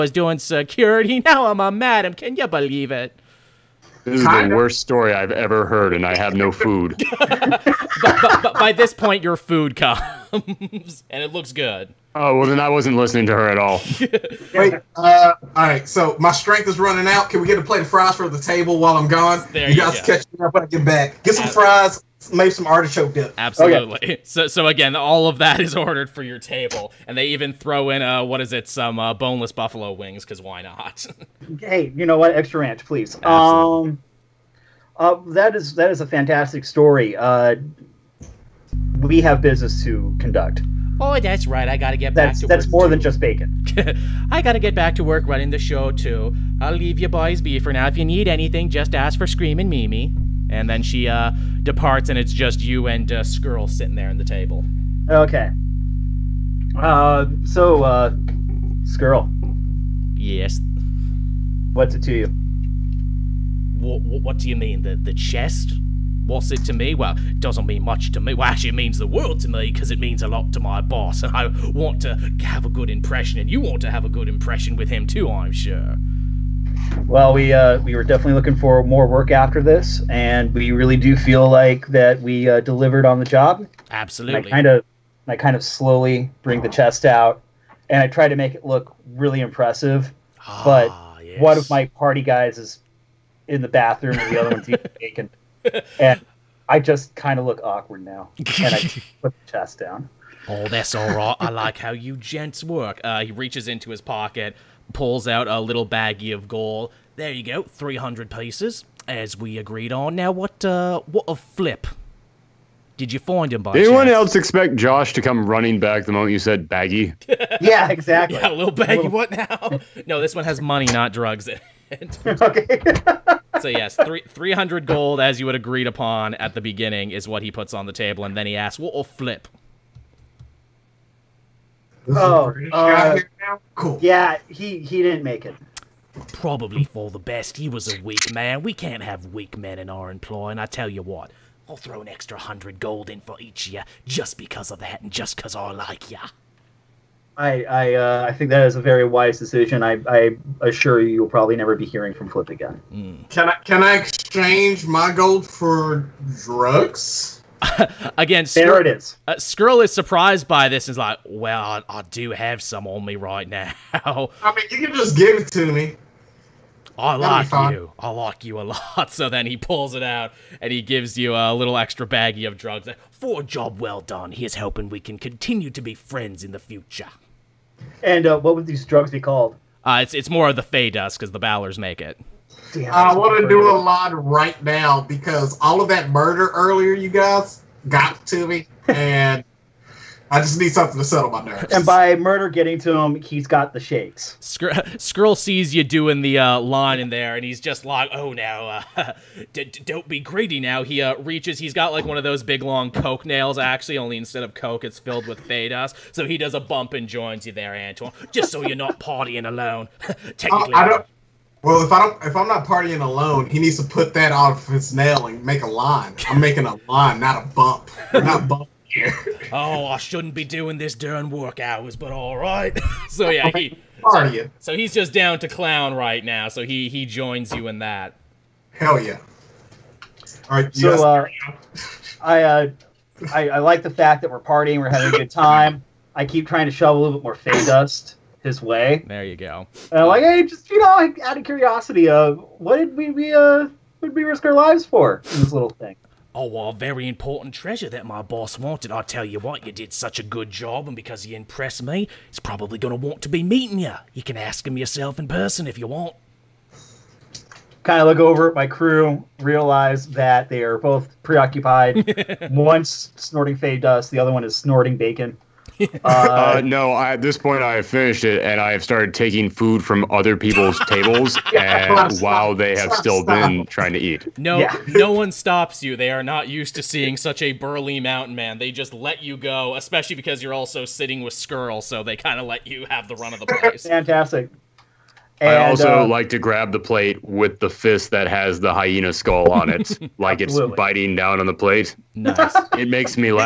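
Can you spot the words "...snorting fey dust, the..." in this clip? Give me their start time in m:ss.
4:23.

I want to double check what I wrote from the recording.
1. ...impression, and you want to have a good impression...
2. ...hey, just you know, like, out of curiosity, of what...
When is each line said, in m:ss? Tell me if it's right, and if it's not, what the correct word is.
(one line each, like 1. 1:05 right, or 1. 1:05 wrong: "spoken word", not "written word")
1. 1:12 right
2. 4:00 right.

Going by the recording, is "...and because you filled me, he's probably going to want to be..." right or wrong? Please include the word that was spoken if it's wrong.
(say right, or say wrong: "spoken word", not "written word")
wrong: "impressed", not "filled".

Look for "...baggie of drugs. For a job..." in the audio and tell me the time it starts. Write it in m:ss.
2:52.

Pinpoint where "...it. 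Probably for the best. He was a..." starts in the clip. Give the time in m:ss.
2:15.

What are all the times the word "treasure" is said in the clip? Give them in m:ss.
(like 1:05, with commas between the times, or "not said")
4:07.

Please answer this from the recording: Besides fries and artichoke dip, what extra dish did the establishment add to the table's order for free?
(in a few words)
boneless buffalo wings.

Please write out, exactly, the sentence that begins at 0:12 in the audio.
Oh well, then I wasn't listening to her at all.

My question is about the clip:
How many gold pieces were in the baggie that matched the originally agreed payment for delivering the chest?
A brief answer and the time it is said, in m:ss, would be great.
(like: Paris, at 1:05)
300, at 1:47.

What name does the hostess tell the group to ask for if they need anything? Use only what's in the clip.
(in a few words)
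Screaming Mimi.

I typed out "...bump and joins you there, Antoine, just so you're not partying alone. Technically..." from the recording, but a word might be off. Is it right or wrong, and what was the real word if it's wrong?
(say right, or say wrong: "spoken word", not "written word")
right.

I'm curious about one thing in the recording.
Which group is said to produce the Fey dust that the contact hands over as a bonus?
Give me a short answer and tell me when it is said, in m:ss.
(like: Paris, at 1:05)
the Bowlers, at 3:01.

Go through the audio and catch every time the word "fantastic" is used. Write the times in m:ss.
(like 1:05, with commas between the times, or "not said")
0:36, 4:43.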